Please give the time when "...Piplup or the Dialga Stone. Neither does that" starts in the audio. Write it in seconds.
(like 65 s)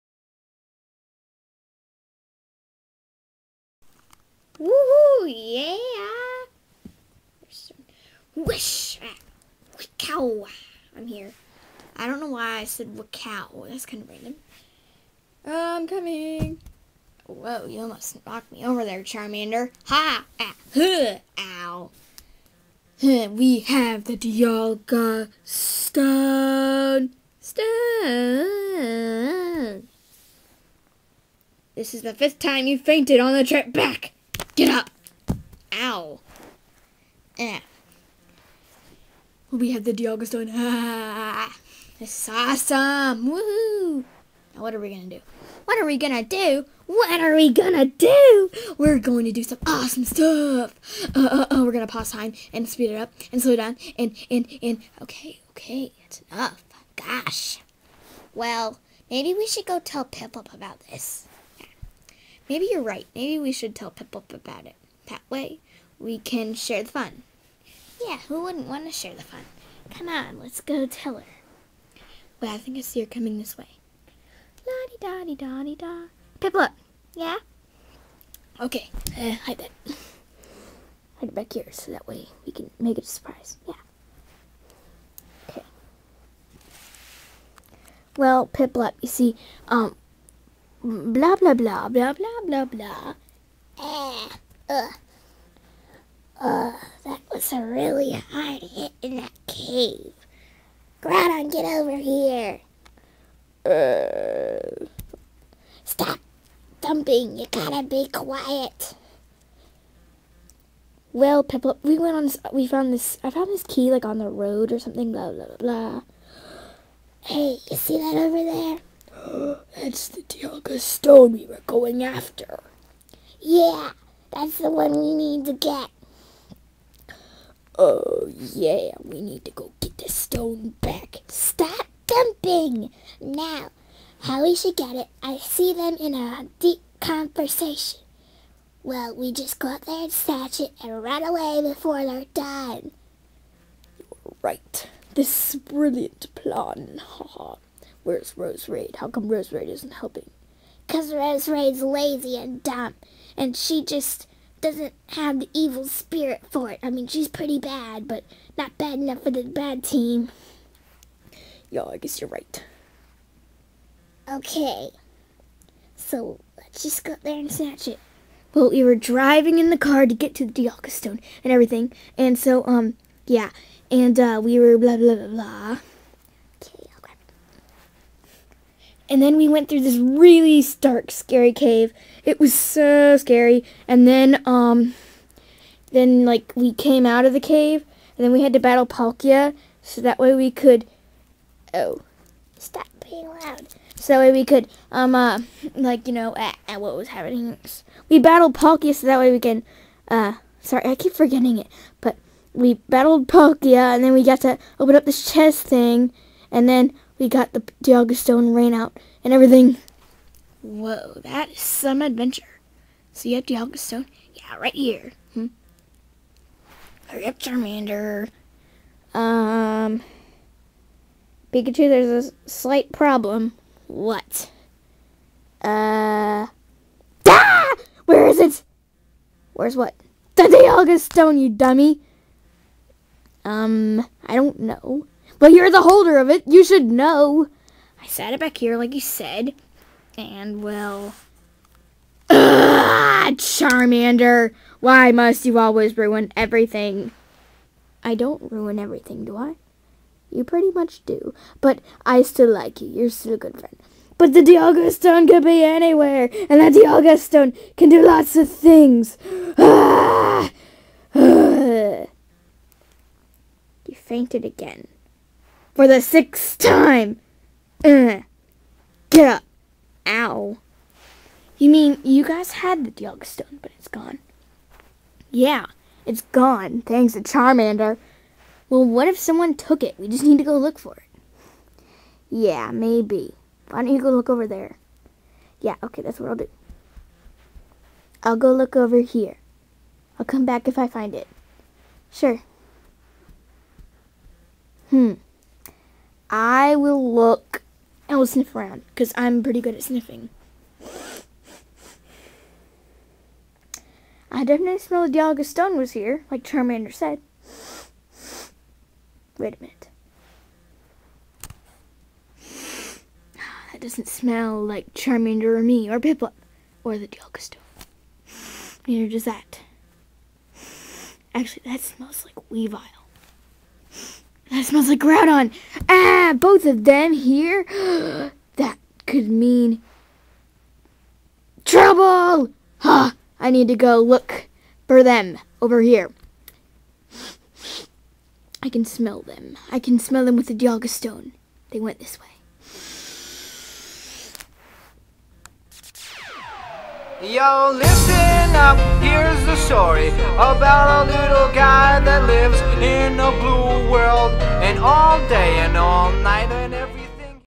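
315 s.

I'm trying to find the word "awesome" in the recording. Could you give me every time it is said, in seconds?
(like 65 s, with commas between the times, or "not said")
42 s, 49 s.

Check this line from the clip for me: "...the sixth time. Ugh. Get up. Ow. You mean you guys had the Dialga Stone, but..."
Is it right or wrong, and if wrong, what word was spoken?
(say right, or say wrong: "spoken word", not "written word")
right.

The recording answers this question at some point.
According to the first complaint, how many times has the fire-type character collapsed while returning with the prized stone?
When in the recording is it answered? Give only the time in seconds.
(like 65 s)
32 s.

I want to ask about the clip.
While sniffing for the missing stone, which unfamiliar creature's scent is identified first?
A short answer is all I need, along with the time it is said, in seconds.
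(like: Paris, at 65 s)
Weavile, at 322 s.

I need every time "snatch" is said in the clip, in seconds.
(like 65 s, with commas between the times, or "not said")
140 s, 167 s.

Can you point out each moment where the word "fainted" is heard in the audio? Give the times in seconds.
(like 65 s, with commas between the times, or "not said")
32 s, 263 s.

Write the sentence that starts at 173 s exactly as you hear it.
And, uh, we were blah, blah, blah, blah.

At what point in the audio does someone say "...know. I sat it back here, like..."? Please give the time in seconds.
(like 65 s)
236 s.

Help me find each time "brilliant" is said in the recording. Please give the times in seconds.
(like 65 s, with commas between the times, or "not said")
145 s.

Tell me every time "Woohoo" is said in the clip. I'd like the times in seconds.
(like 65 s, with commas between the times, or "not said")
4 s, 43 s.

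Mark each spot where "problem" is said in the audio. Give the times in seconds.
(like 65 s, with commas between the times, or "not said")
222 s.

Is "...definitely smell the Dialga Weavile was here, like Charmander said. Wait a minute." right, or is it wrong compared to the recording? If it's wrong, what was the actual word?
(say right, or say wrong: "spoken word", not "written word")
wrong: "Stone", not "Weavile".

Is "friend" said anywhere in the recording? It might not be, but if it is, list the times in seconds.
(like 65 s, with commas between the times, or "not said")
253 s.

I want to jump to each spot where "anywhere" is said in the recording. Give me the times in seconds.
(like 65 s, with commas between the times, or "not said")
255 s.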